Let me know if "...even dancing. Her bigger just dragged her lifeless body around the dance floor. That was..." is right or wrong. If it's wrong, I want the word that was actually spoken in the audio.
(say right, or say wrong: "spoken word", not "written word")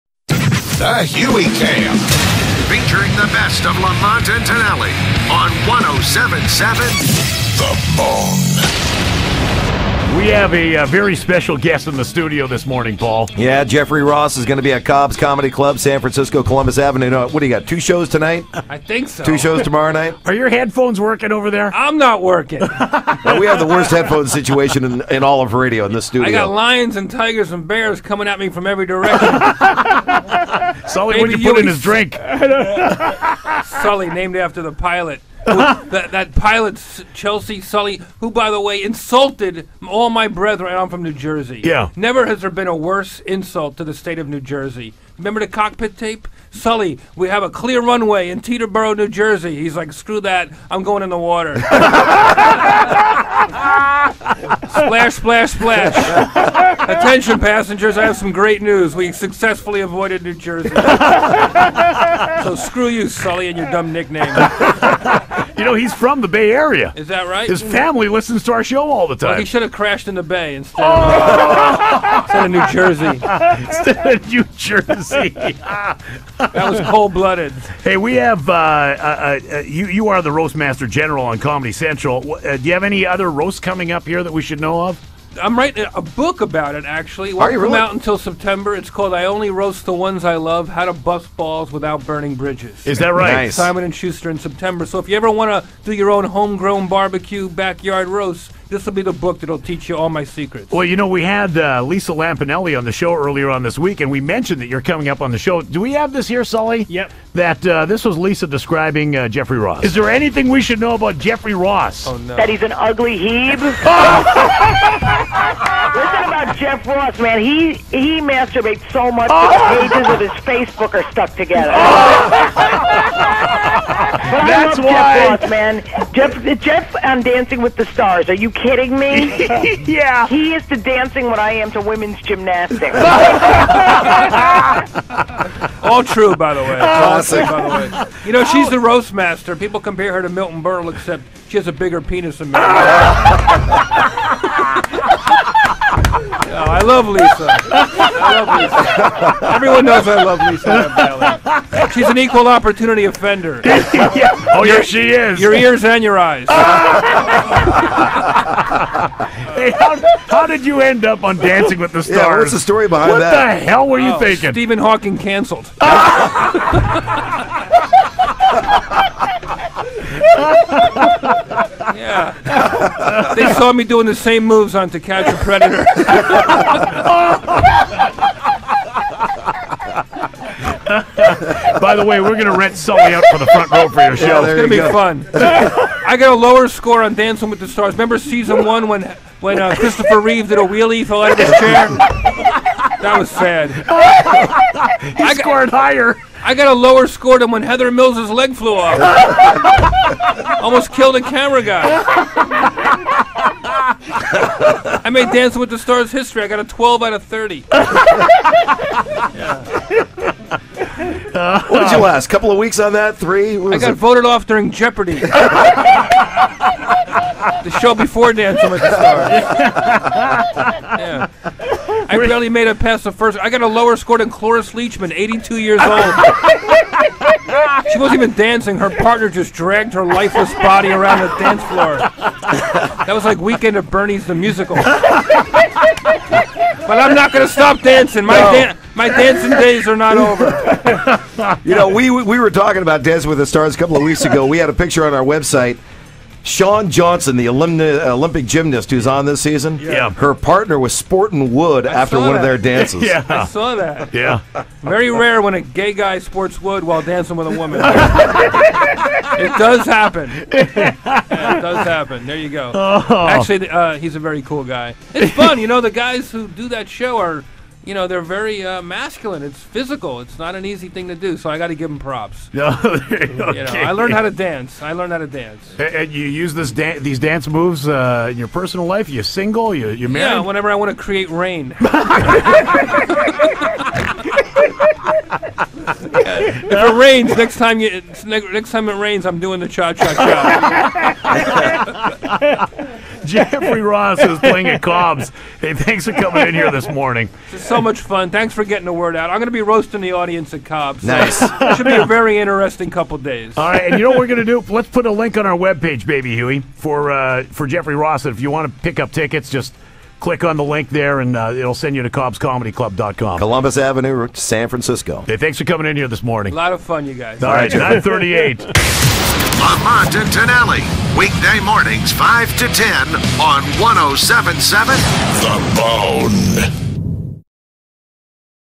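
wrong: "partner", not "bigger".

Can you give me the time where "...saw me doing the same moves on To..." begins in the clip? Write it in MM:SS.
02:53.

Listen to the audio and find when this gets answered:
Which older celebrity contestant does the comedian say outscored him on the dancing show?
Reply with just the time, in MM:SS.
03:44.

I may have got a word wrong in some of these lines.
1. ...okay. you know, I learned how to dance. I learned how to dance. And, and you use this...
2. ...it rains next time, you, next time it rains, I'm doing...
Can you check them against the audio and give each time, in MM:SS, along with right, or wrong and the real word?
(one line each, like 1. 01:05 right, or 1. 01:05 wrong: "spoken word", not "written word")
1. 04:32 right
2. 04:46 right.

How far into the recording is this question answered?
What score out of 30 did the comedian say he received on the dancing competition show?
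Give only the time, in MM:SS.
03:26.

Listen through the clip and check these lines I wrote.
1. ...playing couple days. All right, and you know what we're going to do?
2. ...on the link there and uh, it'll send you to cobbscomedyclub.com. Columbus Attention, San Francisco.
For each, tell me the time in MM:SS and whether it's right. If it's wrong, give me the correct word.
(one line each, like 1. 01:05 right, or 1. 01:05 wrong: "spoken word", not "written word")
1. 05:02 wrong: "interesting", not "playing"
2. 05:10 wrong: "Avenue", not "Attention".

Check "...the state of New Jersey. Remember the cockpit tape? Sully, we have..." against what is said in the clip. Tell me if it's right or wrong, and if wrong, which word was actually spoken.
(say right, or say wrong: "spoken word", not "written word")
right.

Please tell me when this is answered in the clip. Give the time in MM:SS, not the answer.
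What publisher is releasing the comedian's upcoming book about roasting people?
01:33.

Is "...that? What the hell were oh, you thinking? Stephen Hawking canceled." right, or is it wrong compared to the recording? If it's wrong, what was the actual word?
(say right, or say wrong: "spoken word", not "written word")
right.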